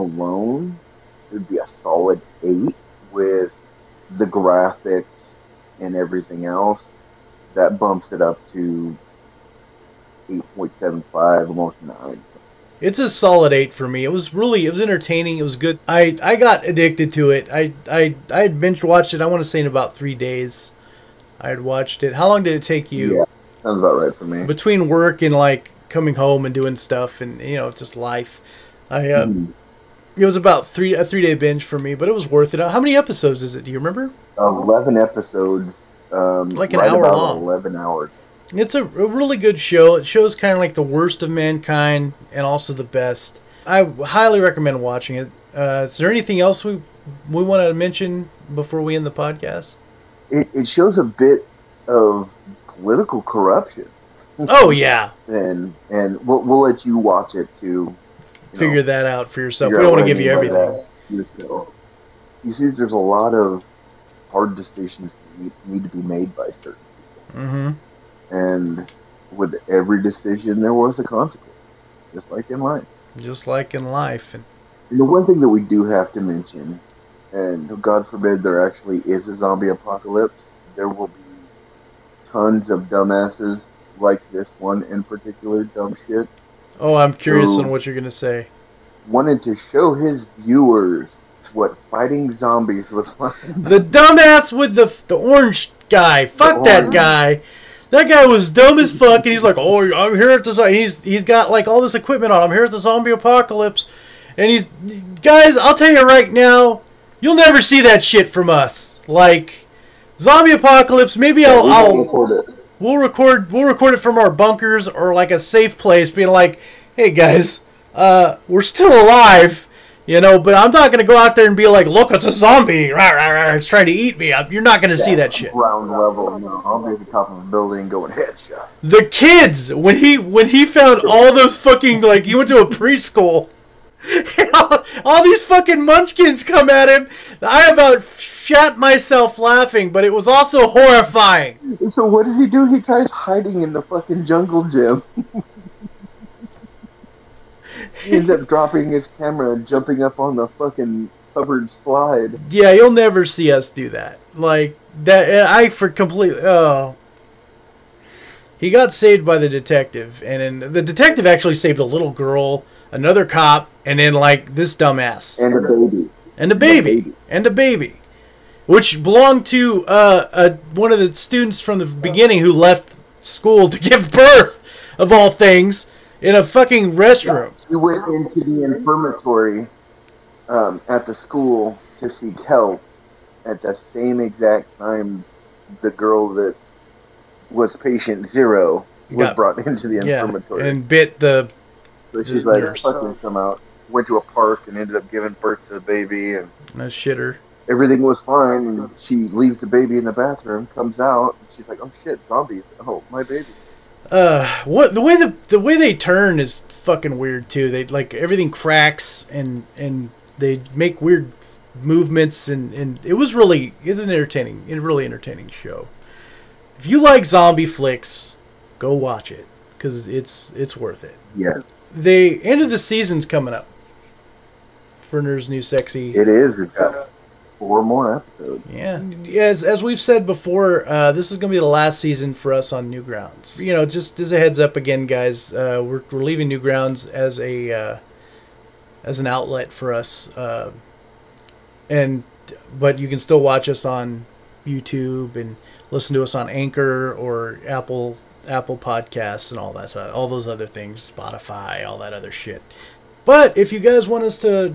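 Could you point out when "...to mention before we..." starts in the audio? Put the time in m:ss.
0:47.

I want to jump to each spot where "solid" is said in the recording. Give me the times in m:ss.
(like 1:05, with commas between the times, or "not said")
0:01, 0:13.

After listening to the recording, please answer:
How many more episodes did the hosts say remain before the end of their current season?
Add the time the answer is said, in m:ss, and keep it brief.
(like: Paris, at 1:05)
4, at 3:47.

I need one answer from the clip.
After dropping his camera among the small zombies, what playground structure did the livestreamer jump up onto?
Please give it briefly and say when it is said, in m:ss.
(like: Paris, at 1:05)
covered slide, at 2:31.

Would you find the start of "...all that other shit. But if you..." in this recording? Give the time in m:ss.
4:11.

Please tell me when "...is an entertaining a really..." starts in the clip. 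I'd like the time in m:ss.
3:33.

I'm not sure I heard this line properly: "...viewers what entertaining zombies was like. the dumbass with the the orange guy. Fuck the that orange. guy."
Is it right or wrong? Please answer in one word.
wrong.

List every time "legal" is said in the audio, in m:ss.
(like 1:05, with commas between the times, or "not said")
not said.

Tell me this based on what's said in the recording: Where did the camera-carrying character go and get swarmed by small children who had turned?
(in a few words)
a preschool.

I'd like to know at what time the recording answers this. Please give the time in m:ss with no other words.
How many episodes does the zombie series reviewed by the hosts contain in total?
0:34.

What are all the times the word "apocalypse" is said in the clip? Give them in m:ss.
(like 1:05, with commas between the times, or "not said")
1:19, 1:43, 1:50.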